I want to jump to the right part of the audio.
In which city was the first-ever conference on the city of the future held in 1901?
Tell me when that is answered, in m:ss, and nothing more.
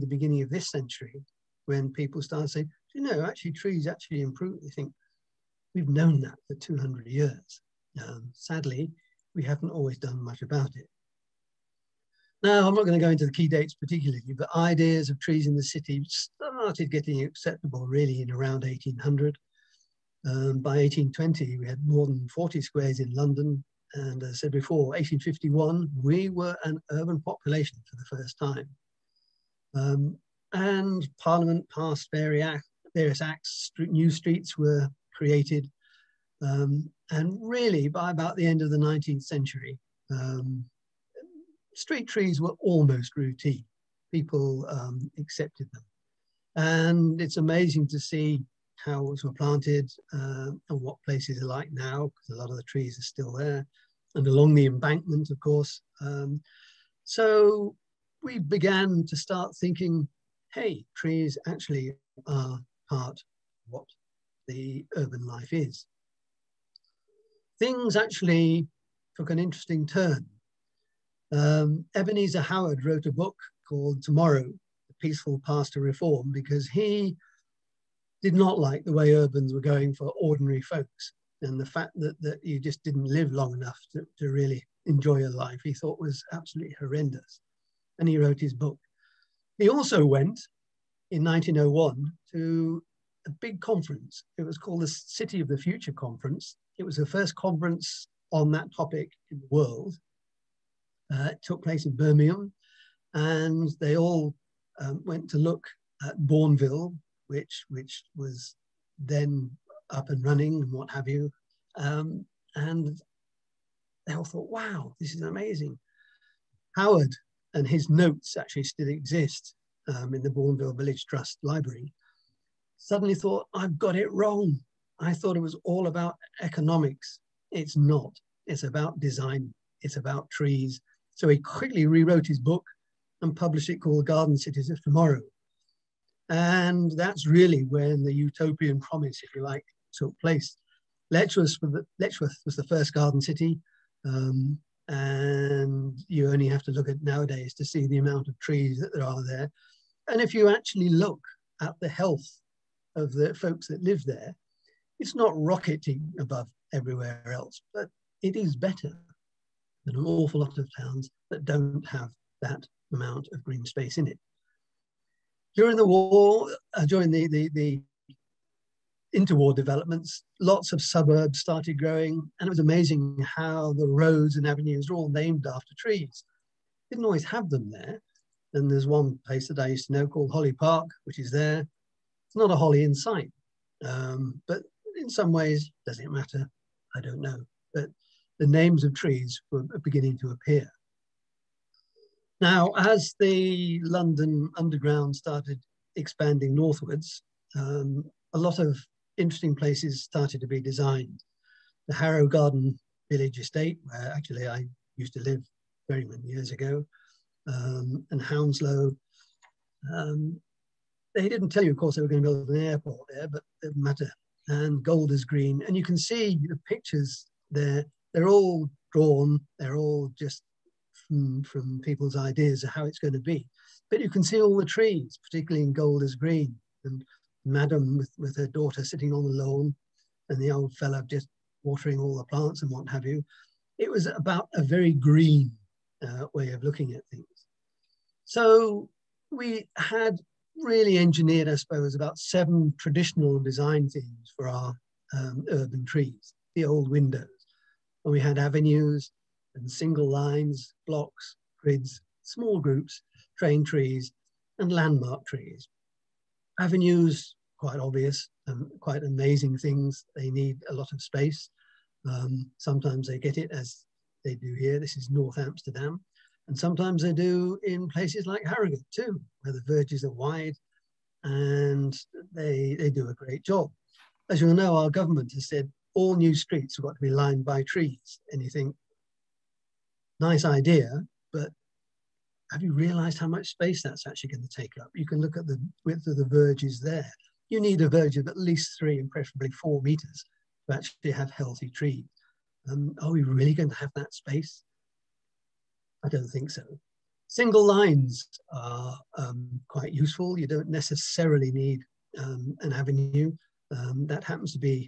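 1:41.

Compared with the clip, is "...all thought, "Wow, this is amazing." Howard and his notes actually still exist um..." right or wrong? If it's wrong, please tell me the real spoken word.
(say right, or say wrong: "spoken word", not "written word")
right.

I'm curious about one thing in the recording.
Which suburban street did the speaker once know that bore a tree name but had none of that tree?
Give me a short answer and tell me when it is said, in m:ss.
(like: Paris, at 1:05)
Holly Park, at 3:00.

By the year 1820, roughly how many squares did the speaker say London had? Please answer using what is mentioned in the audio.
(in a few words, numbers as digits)
more than 40.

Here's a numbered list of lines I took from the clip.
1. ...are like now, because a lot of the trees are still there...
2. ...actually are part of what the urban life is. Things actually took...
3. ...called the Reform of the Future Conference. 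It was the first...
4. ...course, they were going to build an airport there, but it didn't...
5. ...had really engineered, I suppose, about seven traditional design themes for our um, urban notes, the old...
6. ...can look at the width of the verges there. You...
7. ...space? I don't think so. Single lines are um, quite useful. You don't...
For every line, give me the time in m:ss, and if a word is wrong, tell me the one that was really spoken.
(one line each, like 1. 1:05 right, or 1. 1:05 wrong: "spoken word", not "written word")
1. 0:51 right
2. 1:01 right
3. 1:34 wrong: "City", not "Reform"
4. 3:31 right
5. 3:59 wrong: "trees", not "notes"
6. 4:45 right
7. 4:54 right.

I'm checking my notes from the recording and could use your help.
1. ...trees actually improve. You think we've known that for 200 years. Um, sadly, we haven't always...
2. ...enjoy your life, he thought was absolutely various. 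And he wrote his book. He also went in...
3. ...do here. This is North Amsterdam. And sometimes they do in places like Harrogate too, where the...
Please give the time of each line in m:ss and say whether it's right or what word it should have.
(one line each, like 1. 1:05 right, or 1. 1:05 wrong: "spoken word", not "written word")
1. 0:03 right
2. 1:24 wrong: "horrendous", not "various"
3. 4:24 right.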